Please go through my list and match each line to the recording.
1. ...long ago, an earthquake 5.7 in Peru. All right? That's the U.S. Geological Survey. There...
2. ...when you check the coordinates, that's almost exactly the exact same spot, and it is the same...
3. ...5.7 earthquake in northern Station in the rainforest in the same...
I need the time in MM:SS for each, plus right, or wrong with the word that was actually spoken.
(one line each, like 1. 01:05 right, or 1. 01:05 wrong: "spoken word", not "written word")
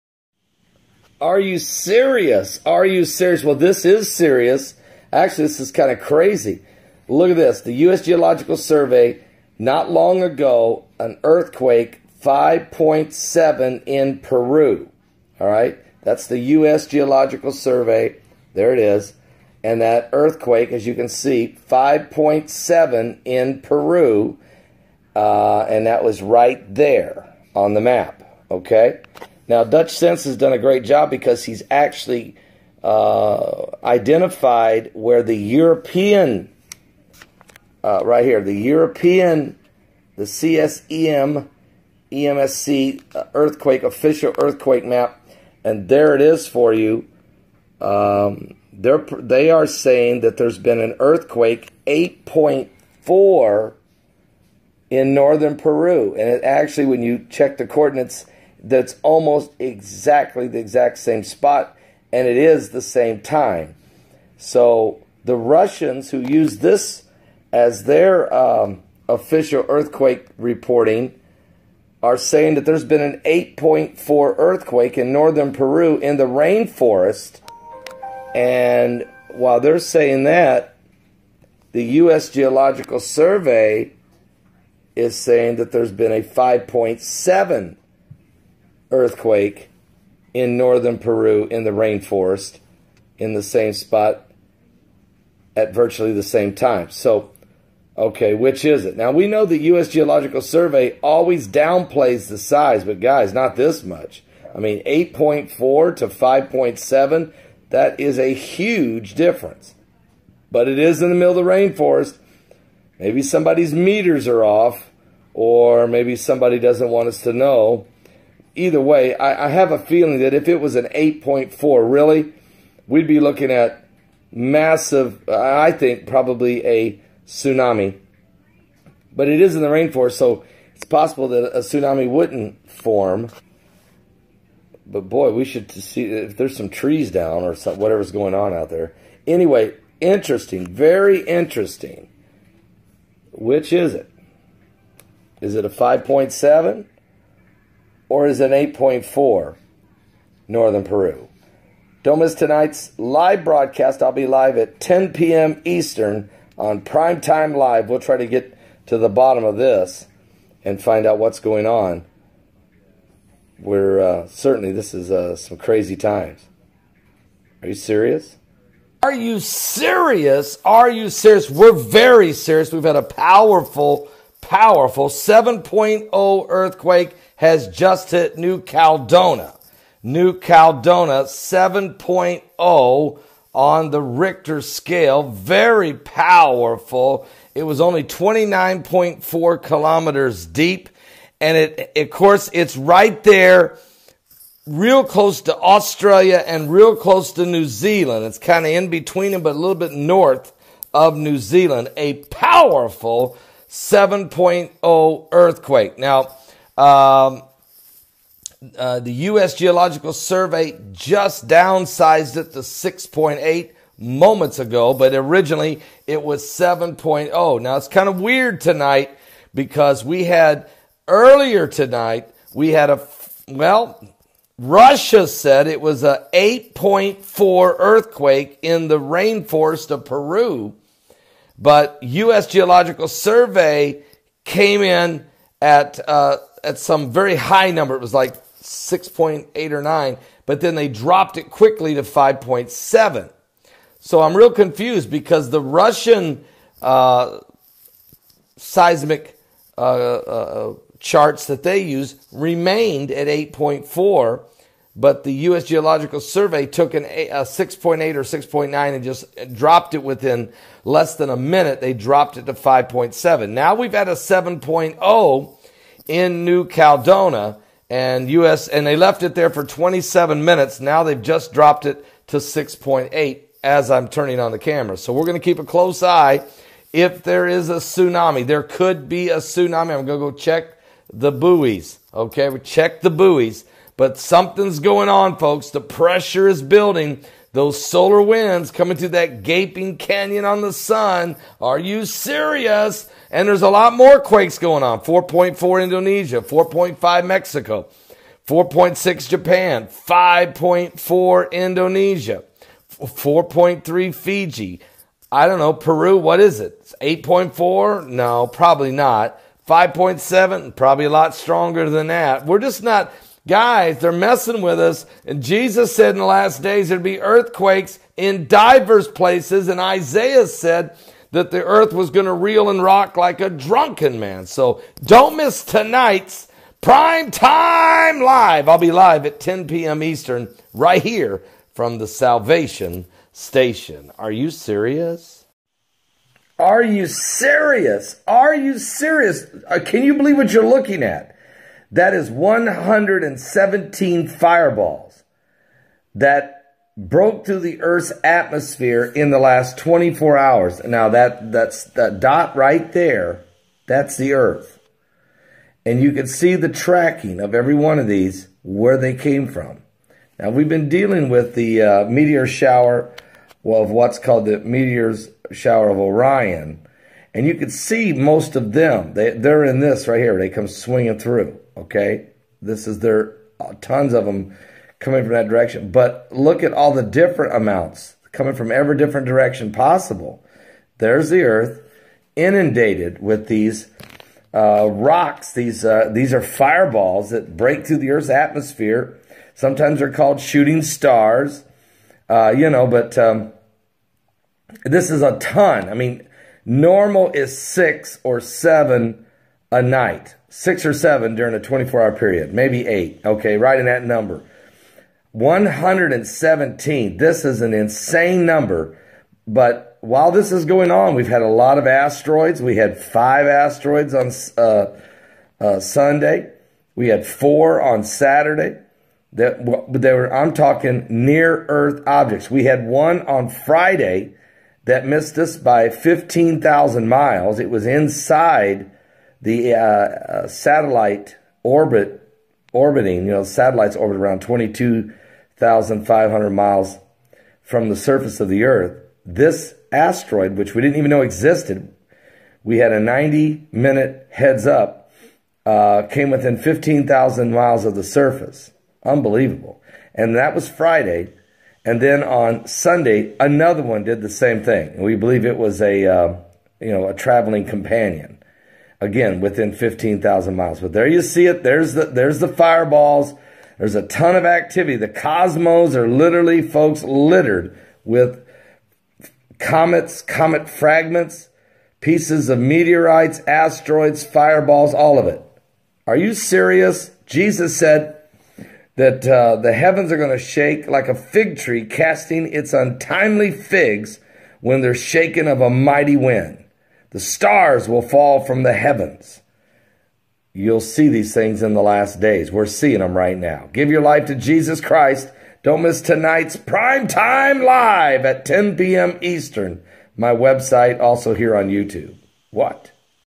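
1. 00:09 right
2. 00:56 right
3. 01:26 wrong: "Peru", not "Station".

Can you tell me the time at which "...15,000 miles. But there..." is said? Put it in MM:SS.
07:39.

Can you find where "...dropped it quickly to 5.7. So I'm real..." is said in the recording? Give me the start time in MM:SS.
04:00.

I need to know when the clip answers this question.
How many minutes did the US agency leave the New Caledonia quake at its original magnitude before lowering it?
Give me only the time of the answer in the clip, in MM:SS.
04:29.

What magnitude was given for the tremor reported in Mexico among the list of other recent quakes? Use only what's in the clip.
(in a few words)
4.5.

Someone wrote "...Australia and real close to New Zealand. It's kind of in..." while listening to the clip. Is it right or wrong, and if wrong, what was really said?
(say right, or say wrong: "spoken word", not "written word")
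right.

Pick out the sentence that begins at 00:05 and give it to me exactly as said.
Actually, this is kind of crazy.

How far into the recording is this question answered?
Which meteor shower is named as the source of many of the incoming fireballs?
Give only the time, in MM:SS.
06:05.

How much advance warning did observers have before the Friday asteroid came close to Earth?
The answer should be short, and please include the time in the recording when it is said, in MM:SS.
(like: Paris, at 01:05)
90 minutes, at 07:22.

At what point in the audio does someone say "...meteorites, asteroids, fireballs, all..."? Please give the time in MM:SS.
07:52.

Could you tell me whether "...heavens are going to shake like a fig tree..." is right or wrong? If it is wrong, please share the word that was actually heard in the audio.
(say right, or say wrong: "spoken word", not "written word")
right.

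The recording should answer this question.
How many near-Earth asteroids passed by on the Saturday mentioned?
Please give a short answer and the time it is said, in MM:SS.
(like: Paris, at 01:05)
4, at 06:57.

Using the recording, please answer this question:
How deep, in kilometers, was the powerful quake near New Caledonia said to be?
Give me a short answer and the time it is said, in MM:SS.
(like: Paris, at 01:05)
29.4, at 03:08.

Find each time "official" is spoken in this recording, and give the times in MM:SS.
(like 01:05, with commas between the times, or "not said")
00:43, 01:09.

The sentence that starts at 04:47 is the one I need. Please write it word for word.
Those solar winds coming through that gaping canyon on the sun.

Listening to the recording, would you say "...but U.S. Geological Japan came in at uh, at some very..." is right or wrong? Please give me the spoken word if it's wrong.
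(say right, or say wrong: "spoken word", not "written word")
wrong: "Survey", not "Japan".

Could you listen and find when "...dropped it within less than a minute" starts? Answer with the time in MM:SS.
04:19.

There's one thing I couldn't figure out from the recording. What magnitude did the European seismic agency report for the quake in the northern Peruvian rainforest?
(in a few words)
8.4.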